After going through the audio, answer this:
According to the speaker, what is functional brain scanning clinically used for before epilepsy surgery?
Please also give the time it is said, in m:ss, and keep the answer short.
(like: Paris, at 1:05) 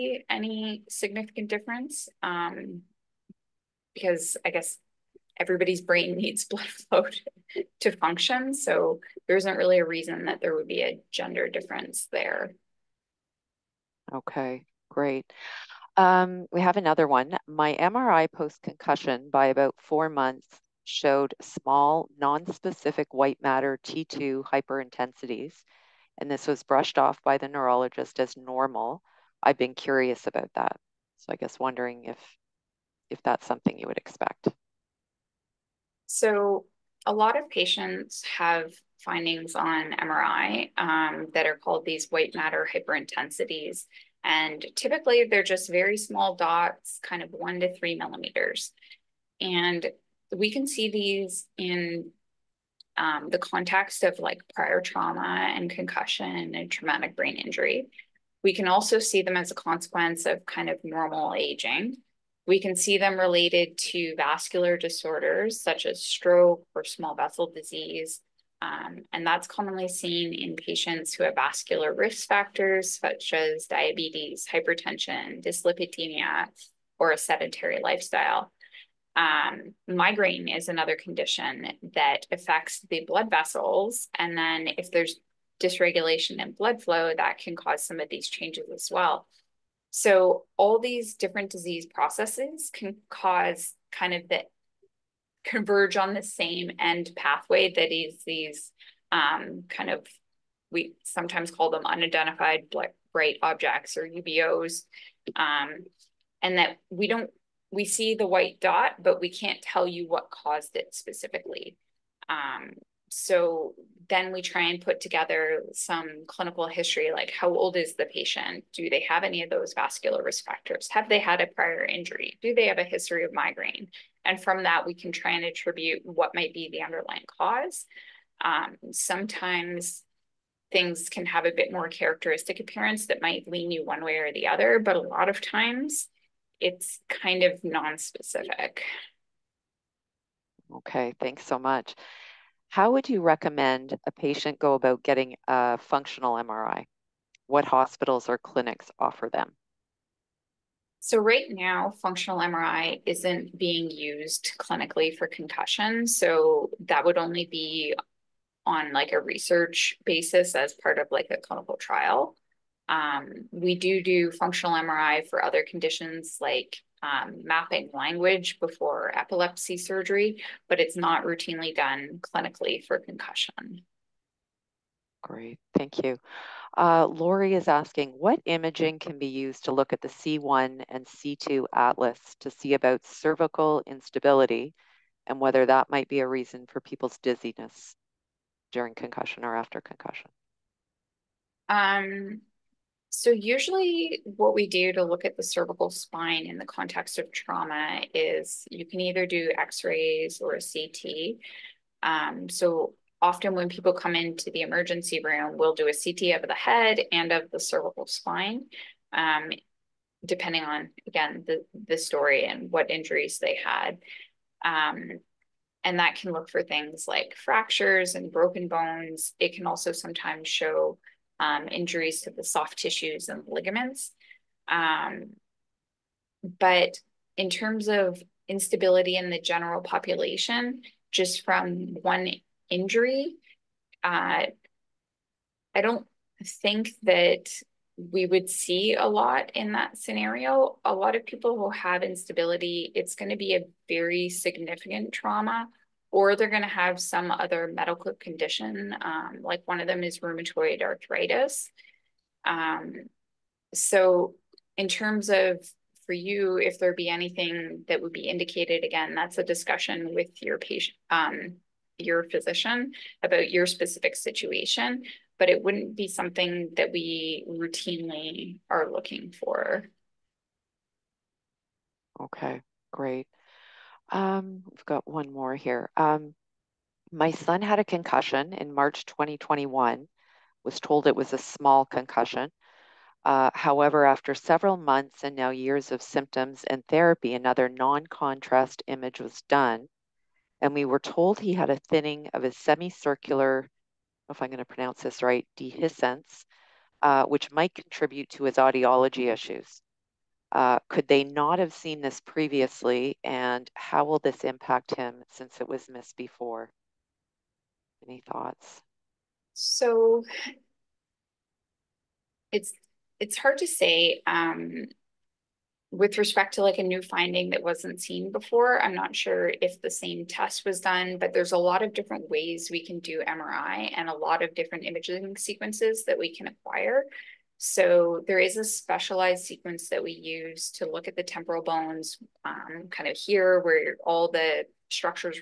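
mapping language, at 2:47.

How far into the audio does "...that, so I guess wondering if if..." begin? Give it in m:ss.
0:30.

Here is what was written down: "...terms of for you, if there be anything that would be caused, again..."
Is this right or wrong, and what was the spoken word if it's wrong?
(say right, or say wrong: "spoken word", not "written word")
wrong: "indicated", not "caused".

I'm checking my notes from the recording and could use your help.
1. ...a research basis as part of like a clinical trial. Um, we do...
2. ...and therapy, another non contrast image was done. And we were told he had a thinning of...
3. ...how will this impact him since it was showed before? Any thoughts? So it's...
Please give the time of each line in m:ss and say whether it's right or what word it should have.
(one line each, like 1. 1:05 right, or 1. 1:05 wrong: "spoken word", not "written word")
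1. 2:39 right
2. 4:46 right
3. 5:03 wrong: "missed", not "showed".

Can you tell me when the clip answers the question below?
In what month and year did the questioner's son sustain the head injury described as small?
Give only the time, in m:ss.
4:38.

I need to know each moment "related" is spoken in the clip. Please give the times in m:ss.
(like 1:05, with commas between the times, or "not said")
1:03.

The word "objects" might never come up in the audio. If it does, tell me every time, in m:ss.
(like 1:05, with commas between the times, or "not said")
1:43.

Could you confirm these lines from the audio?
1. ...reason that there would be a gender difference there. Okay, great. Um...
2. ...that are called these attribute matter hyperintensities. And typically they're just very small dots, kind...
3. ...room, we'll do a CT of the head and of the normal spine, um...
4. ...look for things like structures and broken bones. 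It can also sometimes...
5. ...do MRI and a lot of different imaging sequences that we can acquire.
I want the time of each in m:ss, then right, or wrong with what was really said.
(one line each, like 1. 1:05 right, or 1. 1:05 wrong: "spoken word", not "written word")
1. 0:09 right
2. 0:41 wrong: "white", not "attribute"
3. 3:25 wrong: "cervical", not "normal"
4. 3:36 wrong: "fractures", not "structures"
5. 5:22 right.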